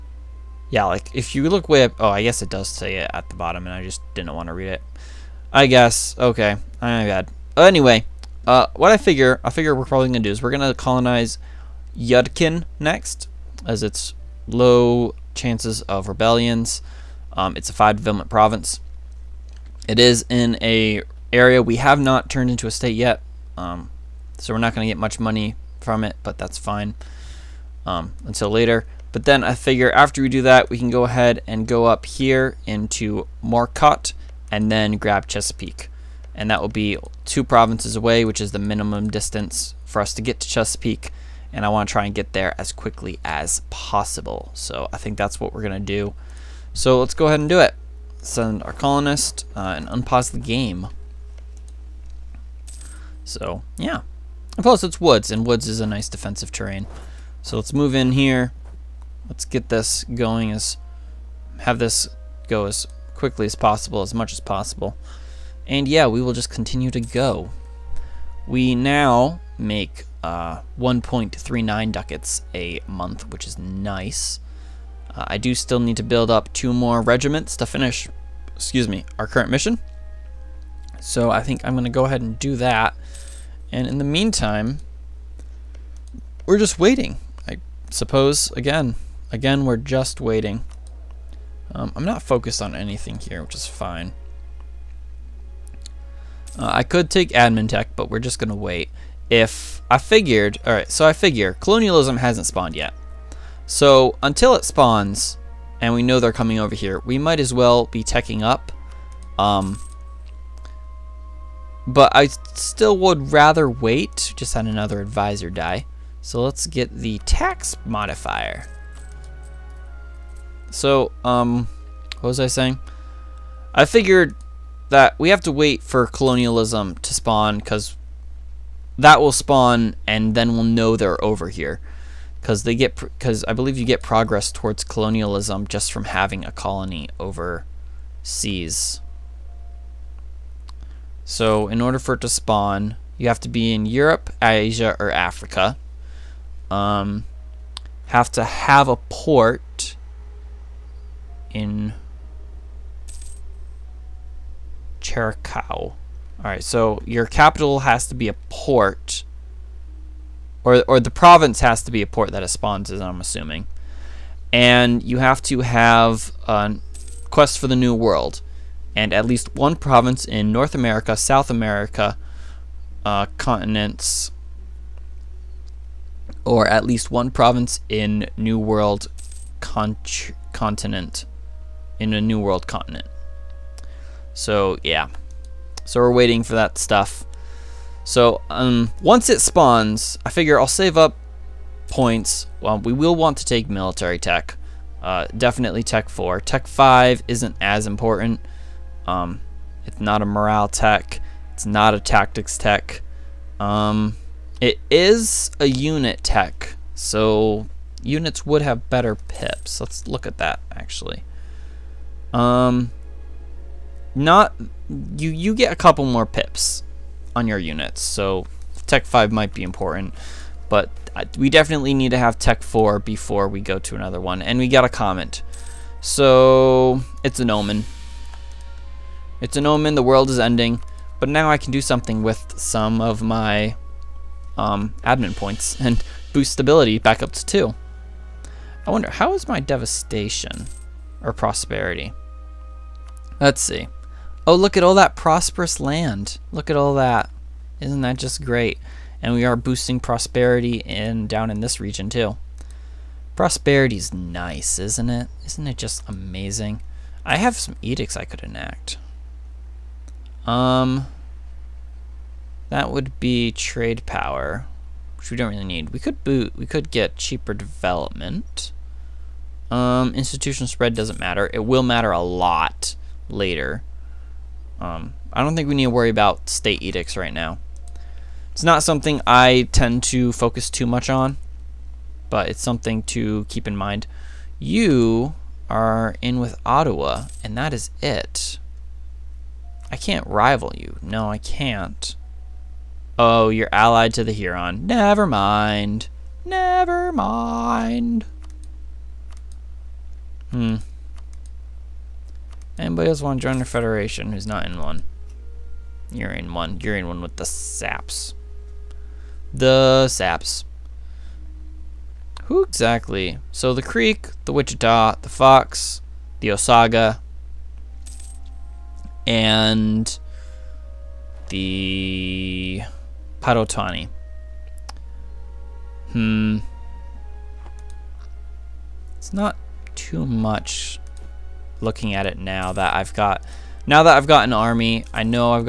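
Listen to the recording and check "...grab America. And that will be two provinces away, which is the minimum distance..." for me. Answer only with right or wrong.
wrong.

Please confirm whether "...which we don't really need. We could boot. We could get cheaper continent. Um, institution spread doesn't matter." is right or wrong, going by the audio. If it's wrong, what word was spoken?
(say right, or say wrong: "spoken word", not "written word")
wrong: "development", not "continent".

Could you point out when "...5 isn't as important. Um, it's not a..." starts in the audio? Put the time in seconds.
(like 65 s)
196 s.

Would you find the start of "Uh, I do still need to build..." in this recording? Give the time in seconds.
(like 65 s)
75 s.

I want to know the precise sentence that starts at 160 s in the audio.
Or, or the province has to be a port that it spawns as I'm assuming.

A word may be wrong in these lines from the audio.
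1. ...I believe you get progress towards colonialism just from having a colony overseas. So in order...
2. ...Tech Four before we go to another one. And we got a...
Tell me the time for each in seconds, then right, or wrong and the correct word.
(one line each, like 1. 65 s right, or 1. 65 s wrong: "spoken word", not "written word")
1. 133 s right
2. 222 s right.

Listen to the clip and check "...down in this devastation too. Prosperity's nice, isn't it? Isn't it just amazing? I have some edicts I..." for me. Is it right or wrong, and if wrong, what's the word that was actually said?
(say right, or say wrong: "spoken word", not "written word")
wrong: "region", not "devastation".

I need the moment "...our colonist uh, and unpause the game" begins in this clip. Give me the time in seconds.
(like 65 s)
48 s.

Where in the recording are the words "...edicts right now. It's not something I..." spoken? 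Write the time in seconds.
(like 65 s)
276 s.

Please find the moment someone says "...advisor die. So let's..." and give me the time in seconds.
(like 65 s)
114 s.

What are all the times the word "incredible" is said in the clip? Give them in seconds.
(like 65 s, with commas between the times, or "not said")
not said.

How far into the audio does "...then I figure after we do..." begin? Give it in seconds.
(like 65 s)
29 s.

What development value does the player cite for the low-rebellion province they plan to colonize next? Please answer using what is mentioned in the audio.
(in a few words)
5.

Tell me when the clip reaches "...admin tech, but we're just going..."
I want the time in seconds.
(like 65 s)
97 s.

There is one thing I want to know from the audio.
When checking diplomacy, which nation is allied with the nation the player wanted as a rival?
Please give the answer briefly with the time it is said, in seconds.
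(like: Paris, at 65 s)
Huron, at 294 s.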